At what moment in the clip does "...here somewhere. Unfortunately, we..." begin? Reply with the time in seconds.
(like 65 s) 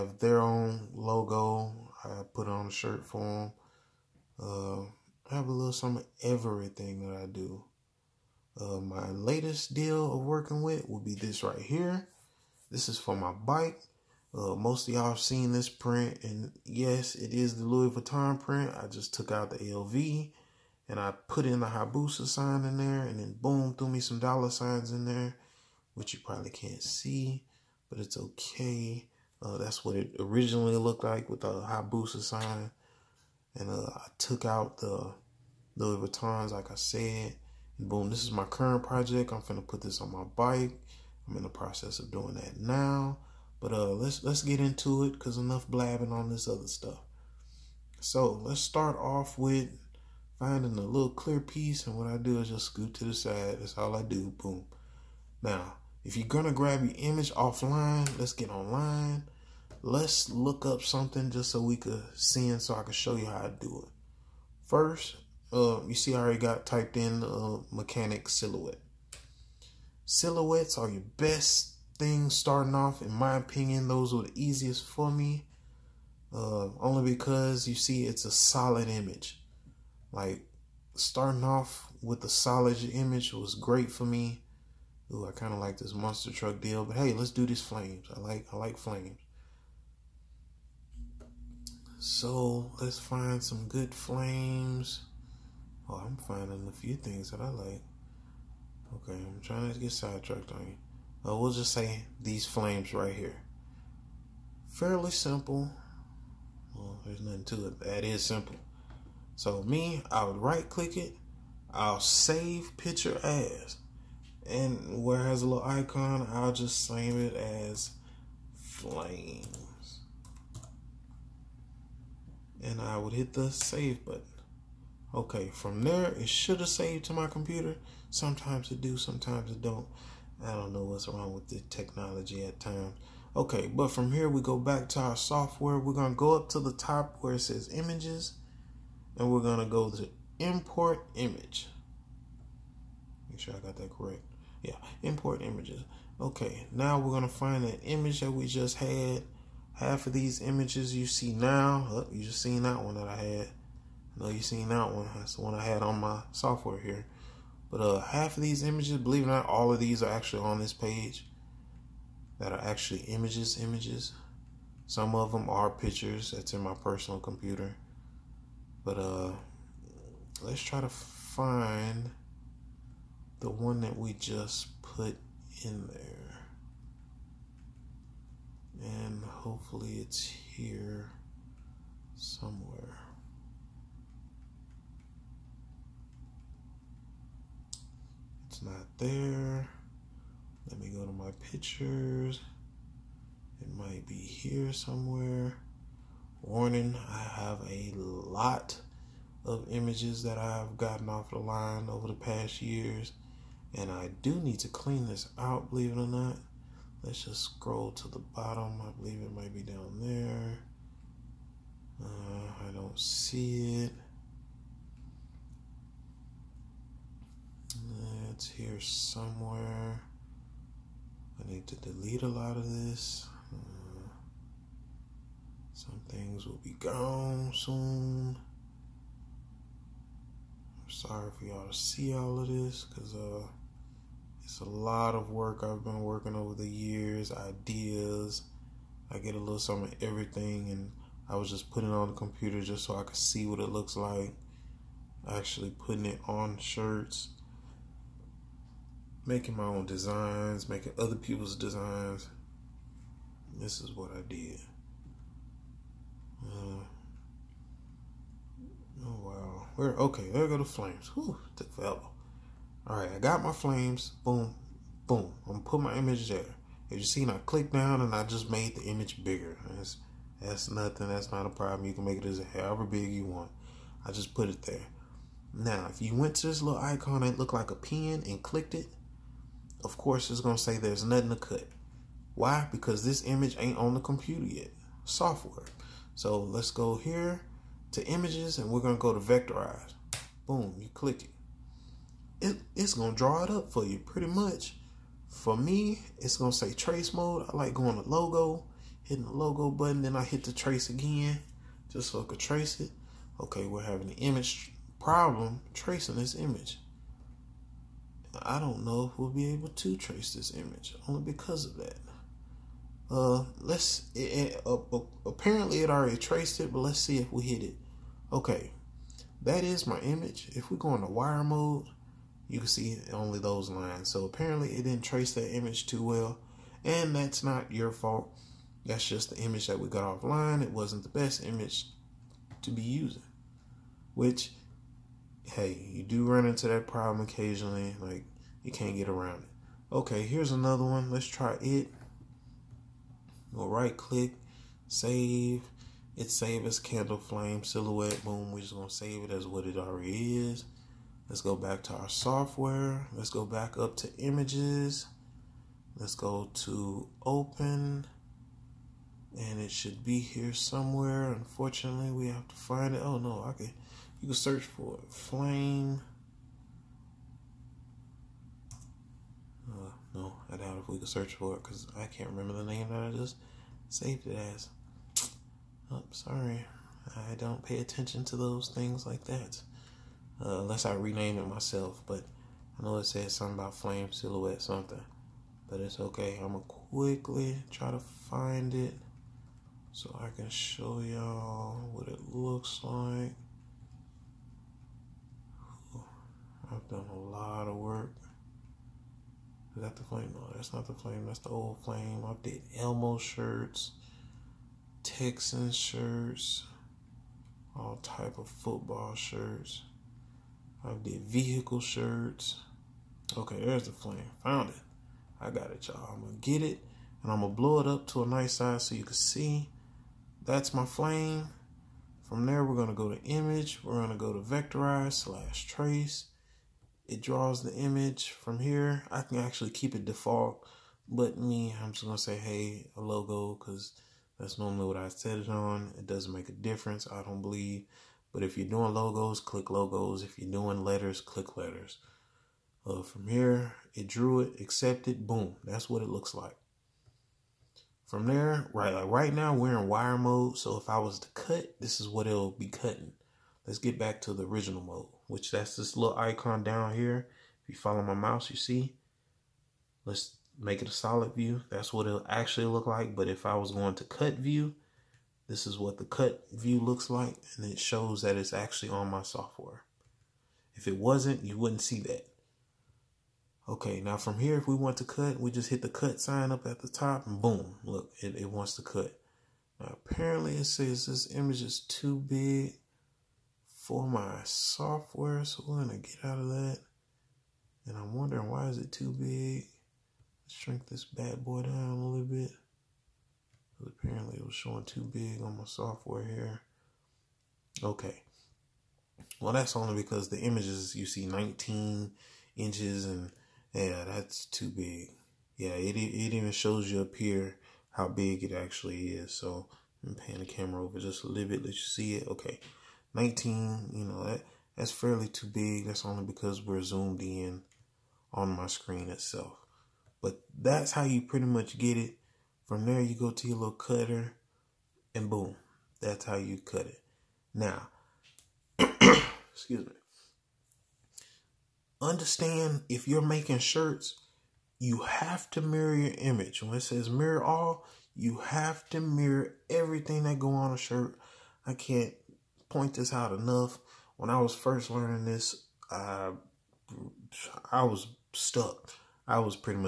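360 s.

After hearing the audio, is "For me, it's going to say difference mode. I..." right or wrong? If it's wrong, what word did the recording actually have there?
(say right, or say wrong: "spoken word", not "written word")
wrong: "trace", not "difference".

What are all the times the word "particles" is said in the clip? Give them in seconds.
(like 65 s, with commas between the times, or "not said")
not said.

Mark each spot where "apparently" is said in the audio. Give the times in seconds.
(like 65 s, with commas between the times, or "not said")
315 s, 324 s, 480 s, 493 s.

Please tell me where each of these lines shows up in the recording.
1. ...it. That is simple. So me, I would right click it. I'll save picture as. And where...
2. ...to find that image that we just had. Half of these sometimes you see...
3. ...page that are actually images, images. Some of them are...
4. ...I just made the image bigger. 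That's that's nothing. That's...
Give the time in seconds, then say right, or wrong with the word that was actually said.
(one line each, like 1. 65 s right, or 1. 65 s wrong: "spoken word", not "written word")
1. 107 s right
2. 147 s wrong: "images", not "sometimes"
3. 160 s right
4. 268 s right.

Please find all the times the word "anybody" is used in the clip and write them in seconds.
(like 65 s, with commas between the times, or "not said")
not said.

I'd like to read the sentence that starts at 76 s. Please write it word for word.
Uh, only because you see it's a solid image.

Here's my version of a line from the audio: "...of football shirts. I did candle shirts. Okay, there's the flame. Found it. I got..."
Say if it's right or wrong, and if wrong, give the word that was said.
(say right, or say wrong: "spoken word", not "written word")
wrong: "vehicle", not "candle".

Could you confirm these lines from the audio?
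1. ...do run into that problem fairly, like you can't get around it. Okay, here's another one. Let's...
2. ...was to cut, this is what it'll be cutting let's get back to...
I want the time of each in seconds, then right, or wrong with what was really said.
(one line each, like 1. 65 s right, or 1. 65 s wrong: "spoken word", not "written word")
1. 336 s wrong: "occasionally", not "fairly"
2. 450 s right.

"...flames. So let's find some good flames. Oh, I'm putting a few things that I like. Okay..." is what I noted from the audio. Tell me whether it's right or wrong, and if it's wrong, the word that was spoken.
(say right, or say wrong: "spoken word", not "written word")
wrong: "finding", not "putting".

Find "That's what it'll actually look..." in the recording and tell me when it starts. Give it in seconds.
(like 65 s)
461 s.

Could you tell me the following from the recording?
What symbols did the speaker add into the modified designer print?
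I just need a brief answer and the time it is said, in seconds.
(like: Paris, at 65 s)
dollar signs, at 24 s.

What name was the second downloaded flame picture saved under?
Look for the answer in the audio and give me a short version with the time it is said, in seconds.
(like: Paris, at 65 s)
candle flame silhouette, at 346 s.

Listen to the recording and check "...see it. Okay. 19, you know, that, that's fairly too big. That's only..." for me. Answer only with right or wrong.
right.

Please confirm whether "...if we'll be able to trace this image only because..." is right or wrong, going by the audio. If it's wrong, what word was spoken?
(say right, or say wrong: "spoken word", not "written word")
right.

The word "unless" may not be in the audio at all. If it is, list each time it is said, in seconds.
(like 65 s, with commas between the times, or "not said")
380 s.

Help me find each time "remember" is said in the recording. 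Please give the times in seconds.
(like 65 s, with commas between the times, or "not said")
372 s.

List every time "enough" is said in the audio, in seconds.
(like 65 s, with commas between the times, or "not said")
45 s, 543 s.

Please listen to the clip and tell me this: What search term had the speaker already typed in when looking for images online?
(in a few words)
mechanic silhouette.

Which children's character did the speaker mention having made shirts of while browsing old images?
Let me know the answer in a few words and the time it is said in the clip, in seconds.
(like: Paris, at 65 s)
Elmo, at 402 s.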